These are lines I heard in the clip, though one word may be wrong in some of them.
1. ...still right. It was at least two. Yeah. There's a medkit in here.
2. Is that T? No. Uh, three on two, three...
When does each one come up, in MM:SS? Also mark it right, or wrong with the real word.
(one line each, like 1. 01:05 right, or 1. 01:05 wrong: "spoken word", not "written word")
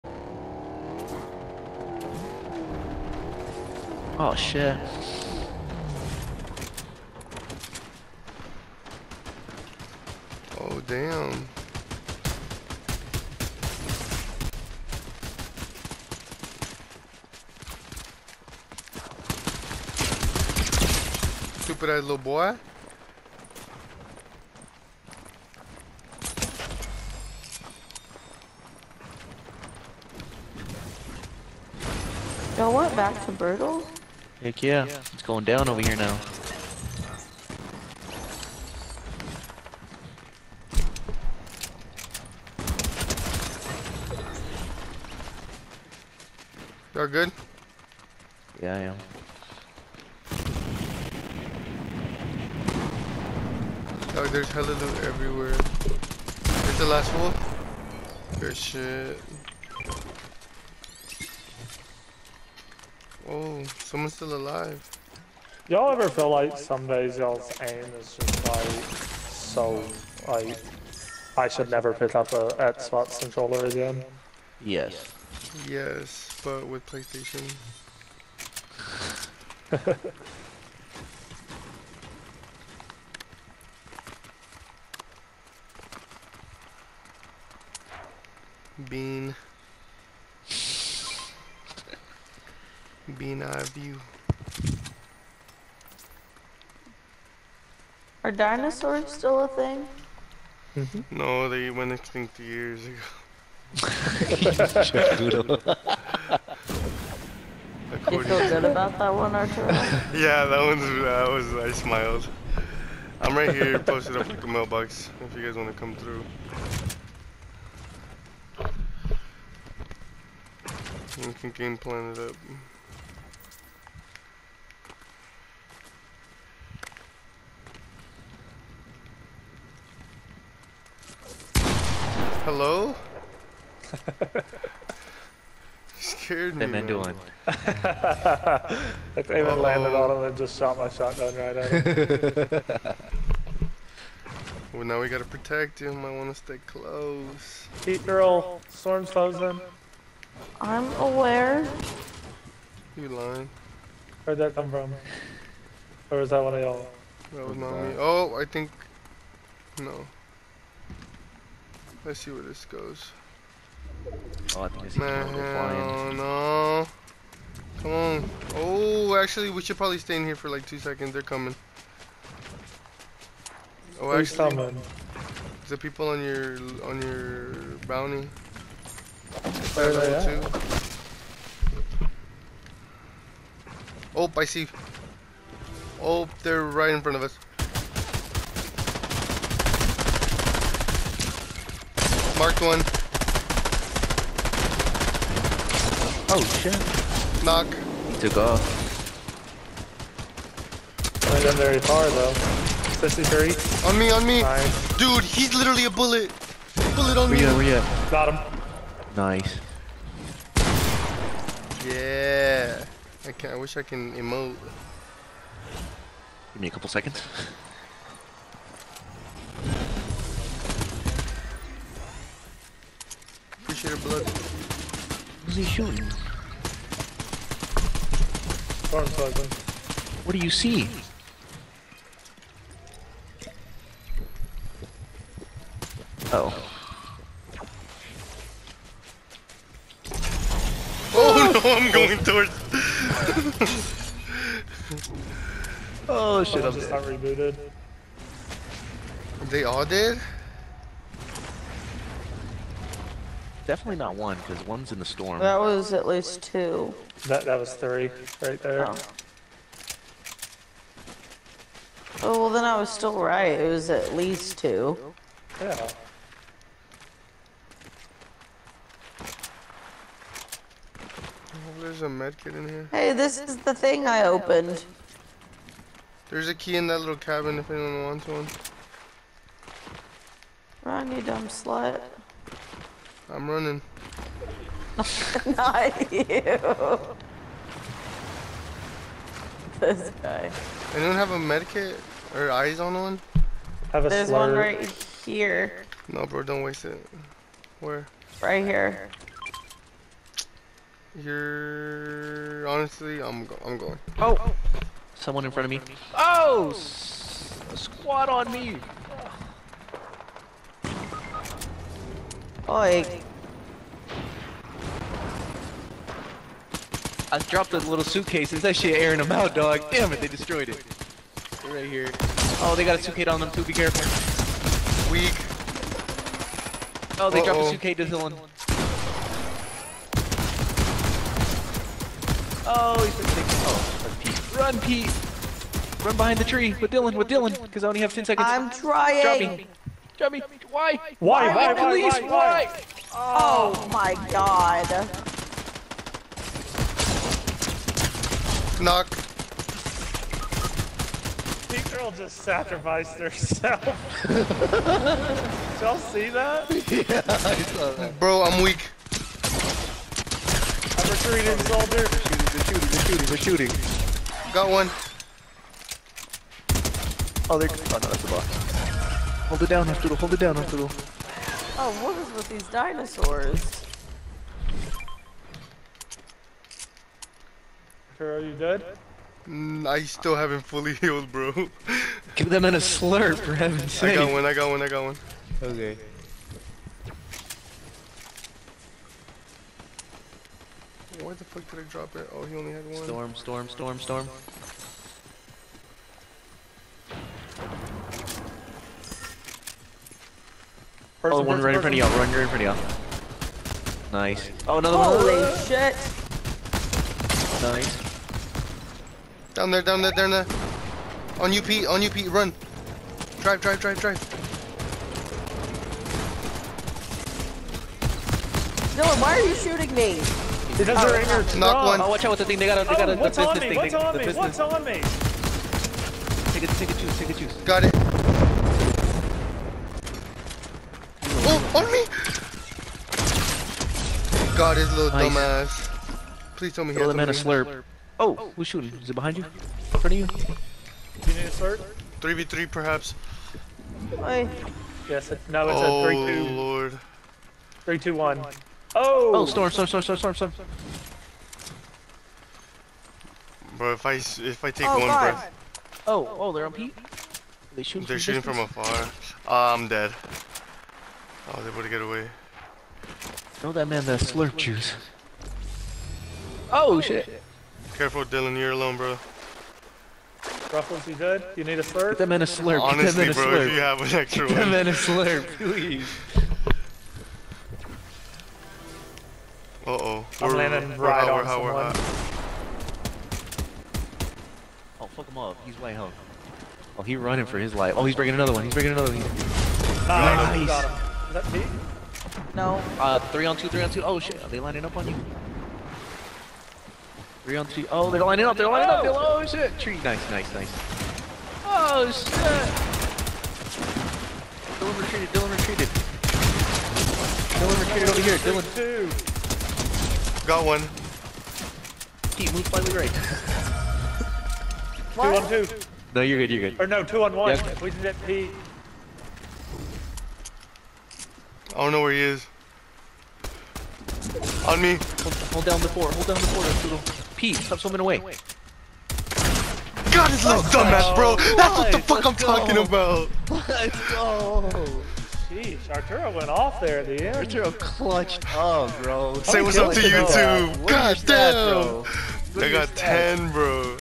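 1. 04:22 right
2. 08:11 right.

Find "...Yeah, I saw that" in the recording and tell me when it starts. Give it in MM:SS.
05:56.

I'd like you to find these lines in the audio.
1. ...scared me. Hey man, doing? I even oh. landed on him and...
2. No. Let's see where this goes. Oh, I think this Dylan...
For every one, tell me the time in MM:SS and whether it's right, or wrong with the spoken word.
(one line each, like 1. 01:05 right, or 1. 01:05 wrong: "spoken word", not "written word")
1. 02:15 right
2. 02:39 wrong: "Man", not "Dylan".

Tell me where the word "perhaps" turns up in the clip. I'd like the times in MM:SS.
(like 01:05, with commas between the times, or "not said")
07:22.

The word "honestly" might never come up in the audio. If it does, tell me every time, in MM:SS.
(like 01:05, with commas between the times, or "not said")
05:02, 07:52.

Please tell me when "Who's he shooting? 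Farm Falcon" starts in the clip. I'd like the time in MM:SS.
03:45.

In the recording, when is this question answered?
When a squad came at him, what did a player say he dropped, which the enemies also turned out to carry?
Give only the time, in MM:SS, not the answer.
05:17.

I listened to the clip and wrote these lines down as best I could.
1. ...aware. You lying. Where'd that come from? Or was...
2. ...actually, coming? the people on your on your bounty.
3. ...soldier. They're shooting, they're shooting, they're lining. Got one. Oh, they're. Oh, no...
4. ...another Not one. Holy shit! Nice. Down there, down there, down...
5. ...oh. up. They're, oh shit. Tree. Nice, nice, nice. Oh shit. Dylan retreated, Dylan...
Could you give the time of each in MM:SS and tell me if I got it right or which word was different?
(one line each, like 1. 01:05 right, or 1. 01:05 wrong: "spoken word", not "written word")
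1. 02:30 right
2. 02:54 right
3. 06:01 wrong: "shooting", not "lining"
4. 06:44 wrong: "Holy", not "Not"
5. 08:18 right.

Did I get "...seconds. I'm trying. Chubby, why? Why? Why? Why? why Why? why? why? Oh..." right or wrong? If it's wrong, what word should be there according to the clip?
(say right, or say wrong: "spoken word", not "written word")
right.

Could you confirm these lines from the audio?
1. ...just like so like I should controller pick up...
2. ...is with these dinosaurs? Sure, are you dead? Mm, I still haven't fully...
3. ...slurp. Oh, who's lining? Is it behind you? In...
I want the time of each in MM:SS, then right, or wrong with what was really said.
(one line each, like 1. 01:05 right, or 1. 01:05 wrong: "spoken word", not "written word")
1. 01:08 wrong: "never", not "controller"
2. 06:12 right
3. 07:17 wrong: "shooting", not "lining".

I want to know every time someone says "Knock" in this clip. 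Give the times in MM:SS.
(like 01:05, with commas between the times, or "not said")
03:17, 05:48, 07:01.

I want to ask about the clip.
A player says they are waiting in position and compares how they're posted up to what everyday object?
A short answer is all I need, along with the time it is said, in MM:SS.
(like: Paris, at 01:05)
a mailbox, at 01:54.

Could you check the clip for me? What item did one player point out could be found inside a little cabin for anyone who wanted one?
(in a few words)
key.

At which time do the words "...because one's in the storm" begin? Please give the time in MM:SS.
04:14.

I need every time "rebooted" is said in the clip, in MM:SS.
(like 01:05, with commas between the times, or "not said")
04:07.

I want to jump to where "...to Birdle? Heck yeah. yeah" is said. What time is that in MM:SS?
00:33.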